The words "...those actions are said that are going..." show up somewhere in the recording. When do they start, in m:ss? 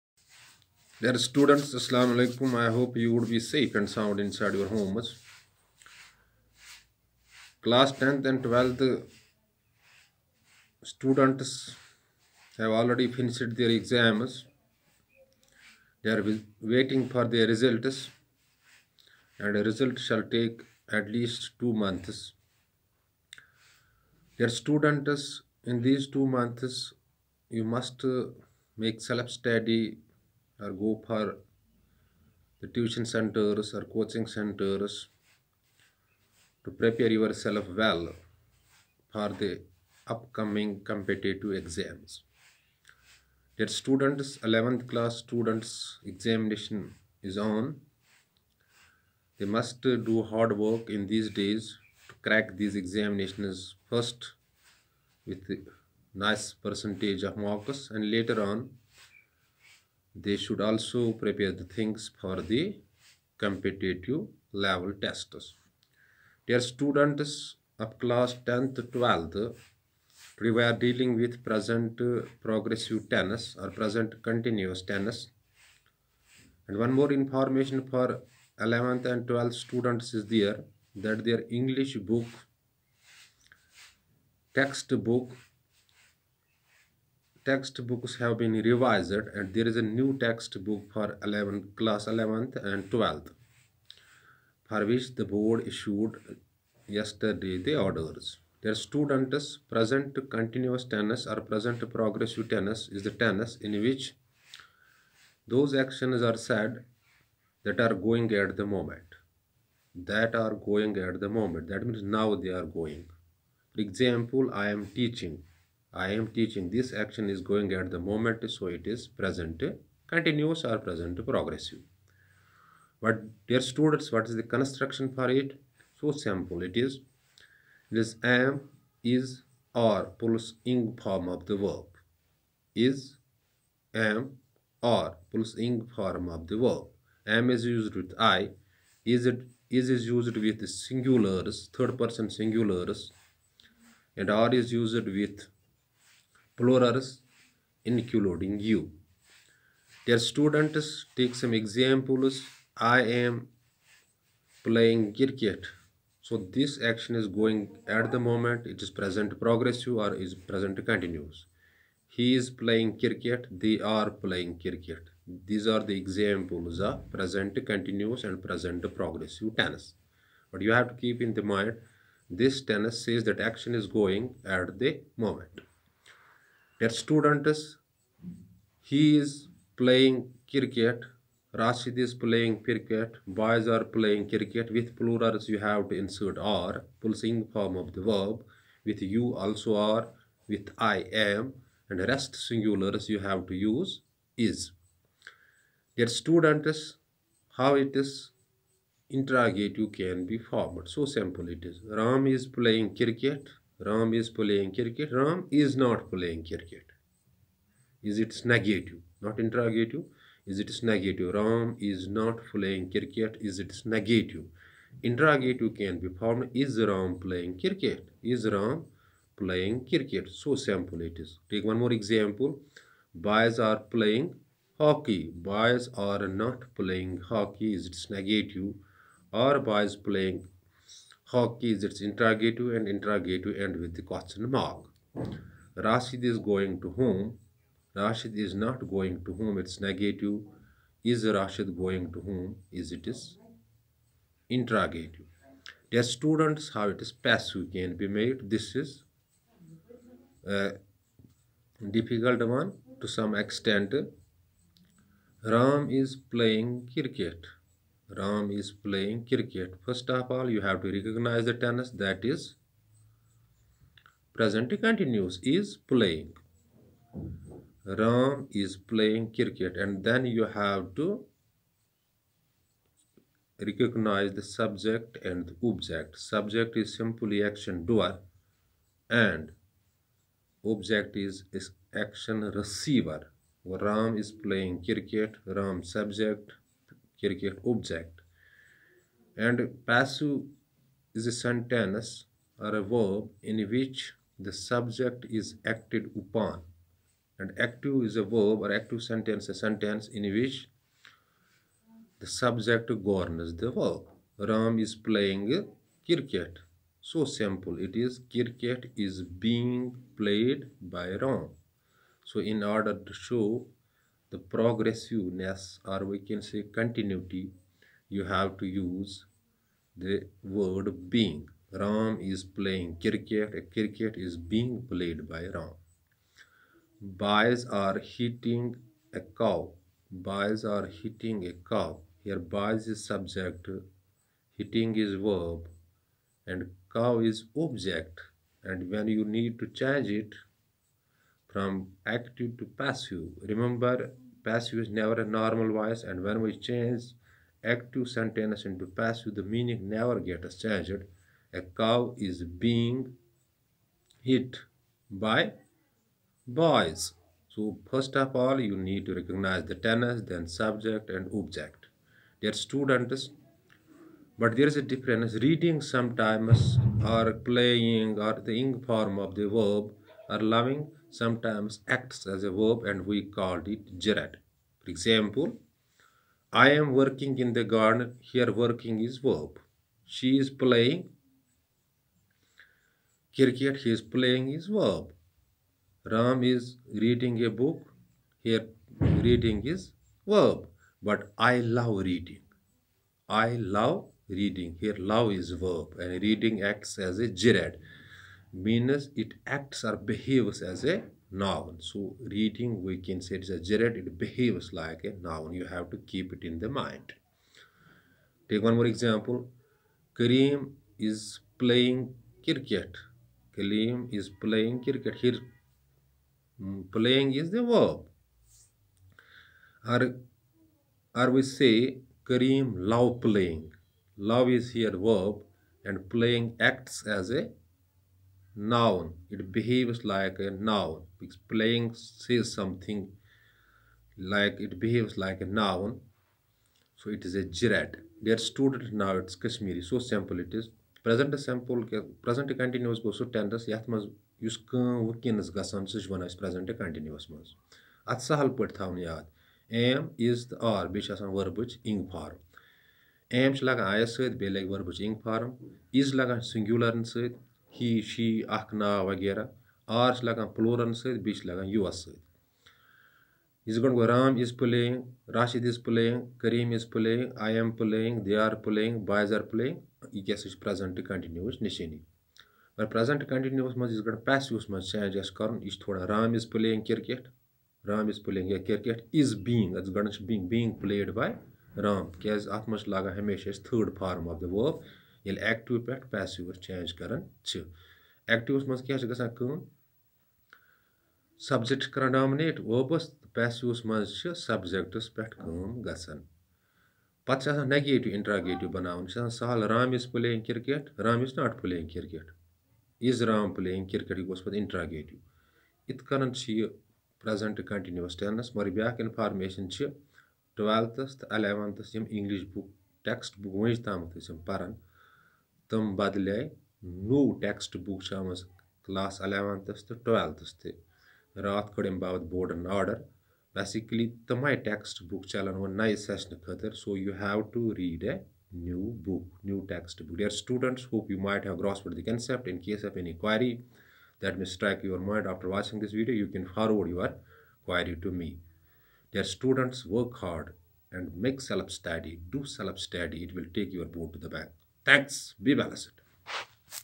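1:45.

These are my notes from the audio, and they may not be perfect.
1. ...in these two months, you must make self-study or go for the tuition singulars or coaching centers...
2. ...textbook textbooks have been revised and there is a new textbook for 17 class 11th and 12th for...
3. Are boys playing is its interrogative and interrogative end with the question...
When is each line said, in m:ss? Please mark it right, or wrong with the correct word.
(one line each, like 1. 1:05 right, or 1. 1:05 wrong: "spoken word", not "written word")
1. 0:25 wrong: "centers", not "singulars"
2. 1:24 wrong: "11", not "17"
3. 3:49 right.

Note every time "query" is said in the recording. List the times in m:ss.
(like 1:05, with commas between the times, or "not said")
8:53, 8:57.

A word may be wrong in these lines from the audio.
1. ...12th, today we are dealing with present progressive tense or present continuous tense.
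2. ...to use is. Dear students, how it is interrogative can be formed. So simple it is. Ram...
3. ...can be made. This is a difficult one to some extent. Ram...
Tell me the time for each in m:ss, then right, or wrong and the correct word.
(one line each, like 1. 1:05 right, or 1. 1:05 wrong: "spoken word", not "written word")
1. 1:08 right
2. 3:13 right
3. 4:07 right.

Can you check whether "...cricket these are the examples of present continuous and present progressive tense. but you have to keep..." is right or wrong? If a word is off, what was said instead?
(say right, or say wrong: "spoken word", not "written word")
right.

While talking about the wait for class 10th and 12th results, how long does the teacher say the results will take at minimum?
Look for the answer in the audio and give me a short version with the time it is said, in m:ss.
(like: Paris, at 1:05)
2 months, at 0:20.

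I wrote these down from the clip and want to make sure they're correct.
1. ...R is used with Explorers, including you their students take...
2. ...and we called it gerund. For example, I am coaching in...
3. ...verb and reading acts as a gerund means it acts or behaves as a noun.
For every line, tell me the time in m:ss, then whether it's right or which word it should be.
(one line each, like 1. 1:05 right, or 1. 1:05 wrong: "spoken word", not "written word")
1. 2:24 right
2. 6:12 wrong: "working", not "coaching"
3. 6:35 right.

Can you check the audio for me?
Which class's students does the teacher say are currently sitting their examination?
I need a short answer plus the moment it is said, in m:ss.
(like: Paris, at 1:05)
11th class, at 0:44.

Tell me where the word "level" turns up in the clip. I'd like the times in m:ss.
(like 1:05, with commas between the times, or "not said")
1:04.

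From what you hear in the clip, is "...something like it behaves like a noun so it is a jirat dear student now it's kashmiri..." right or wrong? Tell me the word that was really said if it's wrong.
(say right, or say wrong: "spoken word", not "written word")
right.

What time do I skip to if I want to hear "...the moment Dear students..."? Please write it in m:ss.
2:54.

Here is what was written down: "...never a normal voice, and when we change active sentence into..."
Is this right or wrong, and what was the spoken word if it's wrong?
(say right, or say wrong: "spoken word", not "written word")
right.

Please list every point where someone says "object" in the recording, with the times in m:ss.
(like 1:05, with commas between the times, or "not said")
4:35, 4:40, 4:47, 5:37, 6:01.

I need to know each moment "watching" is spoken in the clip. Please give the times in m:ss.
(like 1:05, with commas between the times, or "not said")
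8:55.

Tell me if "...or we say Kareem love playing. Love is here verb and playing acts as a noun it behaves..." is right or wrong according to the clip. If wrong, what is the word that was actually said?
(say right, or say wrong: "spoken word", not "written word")
right.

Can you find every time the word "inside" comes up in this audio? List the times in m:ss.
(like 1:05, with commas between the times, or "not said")
0:04.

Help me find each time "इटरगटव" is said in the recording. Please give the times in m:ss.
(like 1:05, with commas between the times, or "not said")
8:18, 8:24.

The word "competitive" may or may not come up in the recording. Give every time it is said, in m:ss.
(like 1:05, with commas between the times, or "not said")
0:40, 1:03.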